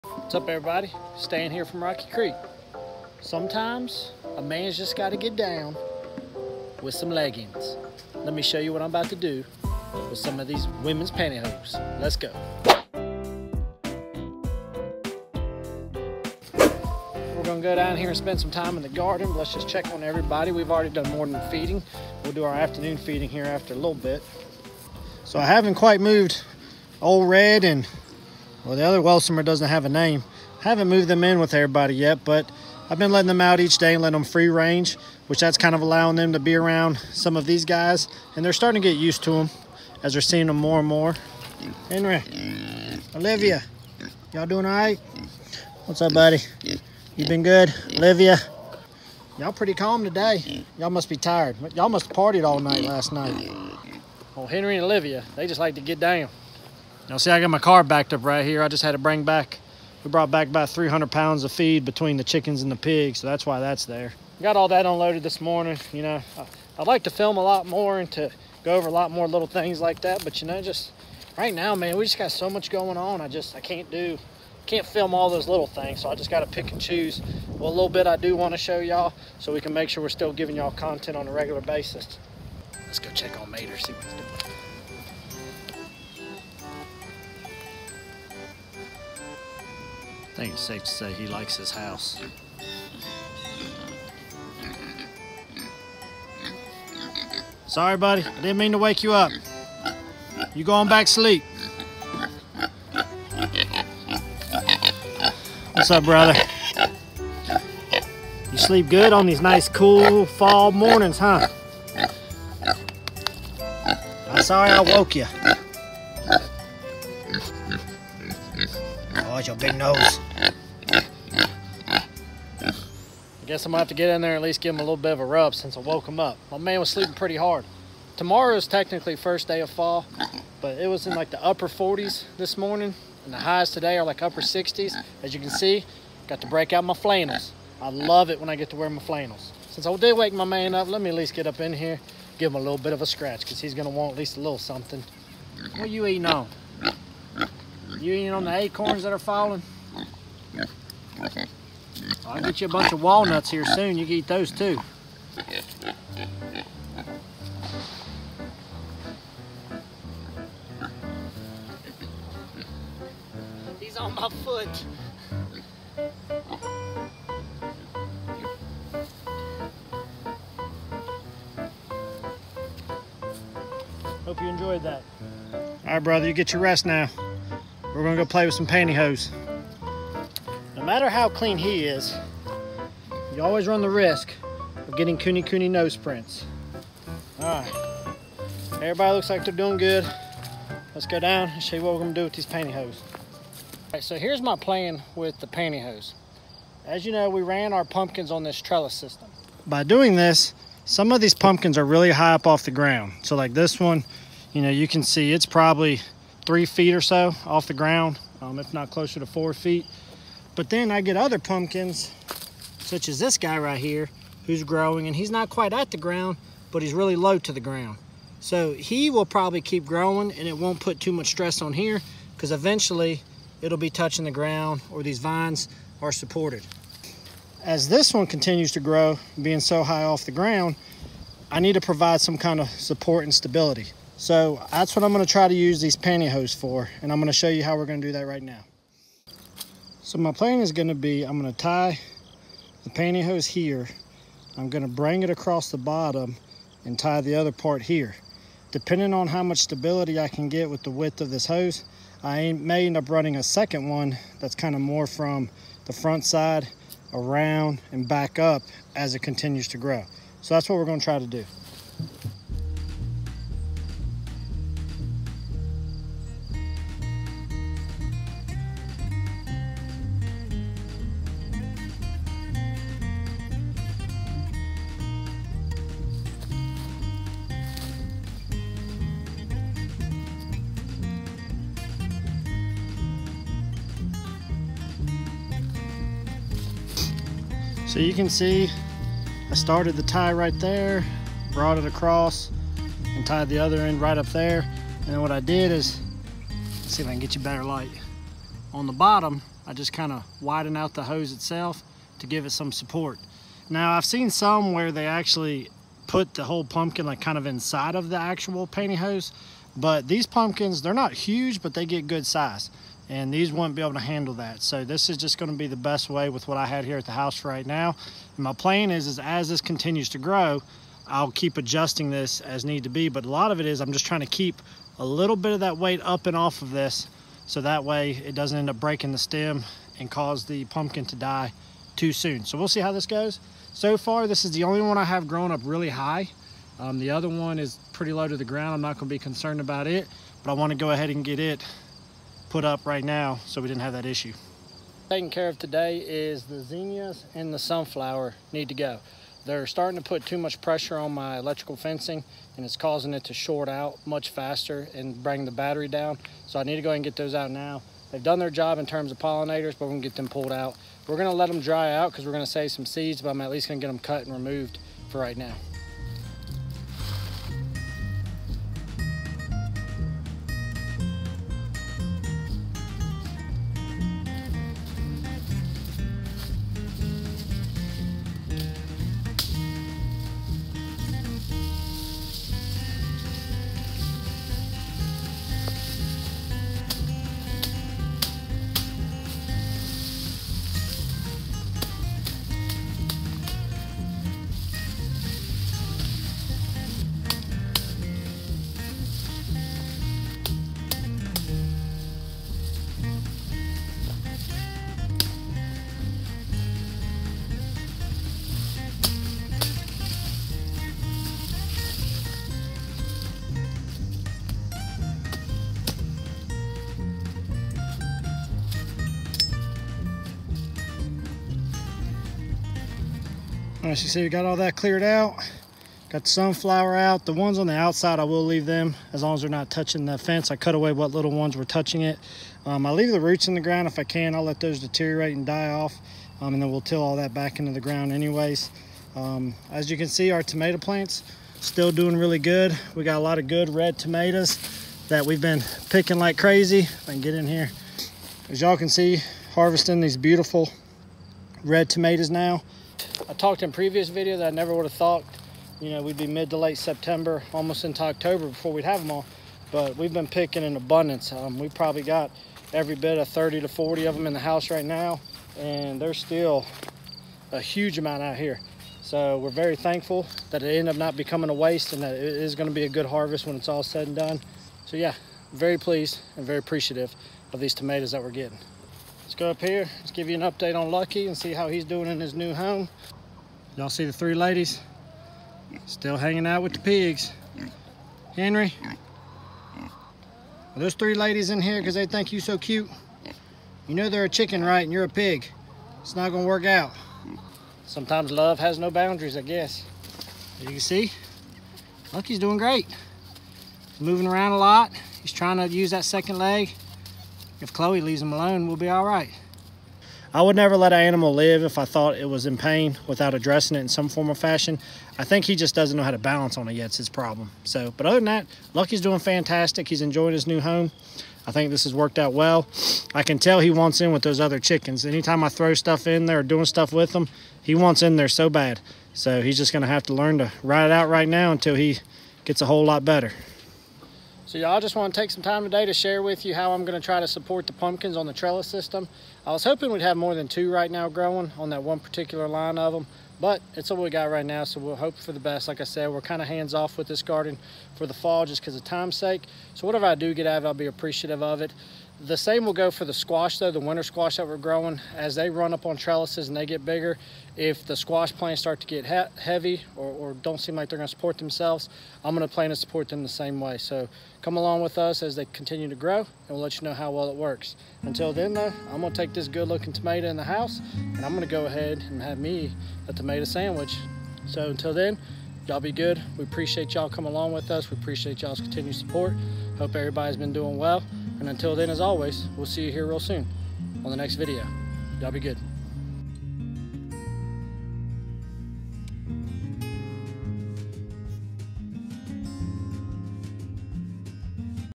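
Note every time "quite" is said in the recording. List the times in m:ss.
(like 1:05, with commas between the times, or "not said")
0:25, 3:35.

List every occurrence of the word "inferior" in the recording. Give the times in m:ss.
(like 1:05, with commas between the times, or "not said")
not said.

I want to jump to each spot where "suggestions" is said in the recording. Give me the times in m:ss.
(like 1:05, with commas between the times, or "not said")
not said.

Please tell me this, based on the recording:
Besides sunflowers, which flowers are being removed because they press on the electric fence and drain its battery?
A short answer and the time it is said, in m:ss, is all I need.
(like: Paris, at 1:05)
Zinnias, at 5:46.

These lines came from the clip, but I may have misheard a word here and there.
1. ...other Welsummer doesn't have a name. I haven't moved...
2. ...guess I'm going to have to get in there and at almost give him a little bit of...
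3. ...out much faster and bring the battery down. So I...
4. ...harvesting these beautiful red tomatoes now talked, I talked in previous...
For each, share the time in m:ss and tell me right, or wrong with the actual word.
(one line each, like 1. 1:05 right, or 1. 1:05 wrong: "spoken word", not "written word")
1. 0:28 right
2. 2:03 wrong: "least", not "almost"
3. 5:53 right
4. 7:29 right.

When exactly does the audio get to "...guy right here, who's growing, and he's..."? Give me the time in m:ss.
3:33.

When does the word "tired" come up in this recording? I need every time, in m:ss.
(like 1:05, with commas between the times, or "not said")
0:51.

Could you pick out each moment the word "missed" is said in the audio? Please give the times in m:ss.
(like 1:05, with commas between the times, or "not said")
not said.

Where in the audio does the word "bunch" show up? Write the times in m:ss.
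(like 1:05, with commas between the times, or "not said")
2:32.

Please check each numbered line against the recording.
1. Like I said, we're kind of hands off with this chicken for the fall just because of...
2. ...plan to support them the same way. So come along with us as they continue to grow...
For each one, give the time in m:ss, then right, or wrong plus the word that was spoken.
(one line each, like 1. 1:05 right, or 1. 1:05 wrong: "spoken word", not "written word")
1. 9:05 wrong: "garden", not "chicken"
2. 9:22 right.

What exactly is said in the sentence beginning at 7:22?
We got a lot of good red tomatoes that we've been picking like crazy.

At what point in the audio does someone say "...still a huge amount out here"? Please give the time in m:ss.
7:46.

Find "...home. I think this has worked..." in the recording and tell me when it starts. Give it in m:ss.
8:40.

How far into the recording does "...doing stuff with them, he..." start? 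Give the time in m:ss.
8:46.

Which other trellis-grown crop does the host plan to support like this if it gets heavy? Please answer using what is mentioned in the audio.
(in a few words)
Winter squash.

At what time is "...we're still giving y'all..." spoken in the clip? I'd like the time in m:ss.
1:20.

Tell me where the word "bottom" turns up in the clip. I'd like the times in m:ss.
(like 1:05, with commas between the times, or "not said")
4:05, 4:58.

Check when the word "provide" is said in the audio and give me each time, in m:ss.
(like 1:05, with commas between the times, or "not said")
3:51.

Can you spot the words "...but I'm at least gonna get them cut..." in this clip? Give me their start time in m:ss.
6:03.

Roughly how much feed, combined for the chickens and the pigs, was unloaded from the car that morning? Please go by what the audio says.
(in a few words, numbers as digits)
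300 pounds.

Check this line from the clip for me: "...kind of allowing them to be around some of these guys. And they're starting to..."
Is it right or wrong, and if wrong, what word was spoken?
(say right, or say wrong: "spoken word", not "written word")
right.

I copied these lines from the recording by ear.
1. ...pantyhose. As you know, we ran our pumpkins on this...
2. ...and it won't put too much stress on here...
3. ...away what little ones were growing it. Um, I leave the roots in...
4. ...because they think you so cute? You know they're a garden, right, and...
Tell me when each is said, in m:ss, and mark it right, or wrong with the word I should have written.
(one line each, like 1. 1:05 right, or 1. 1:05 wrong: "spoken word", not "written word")
1. 3:15 right
2. 3:40 right
3. 7:10 wrong: "touching", not "growing"
4. 8:11 wrong: "chicken", not "garden".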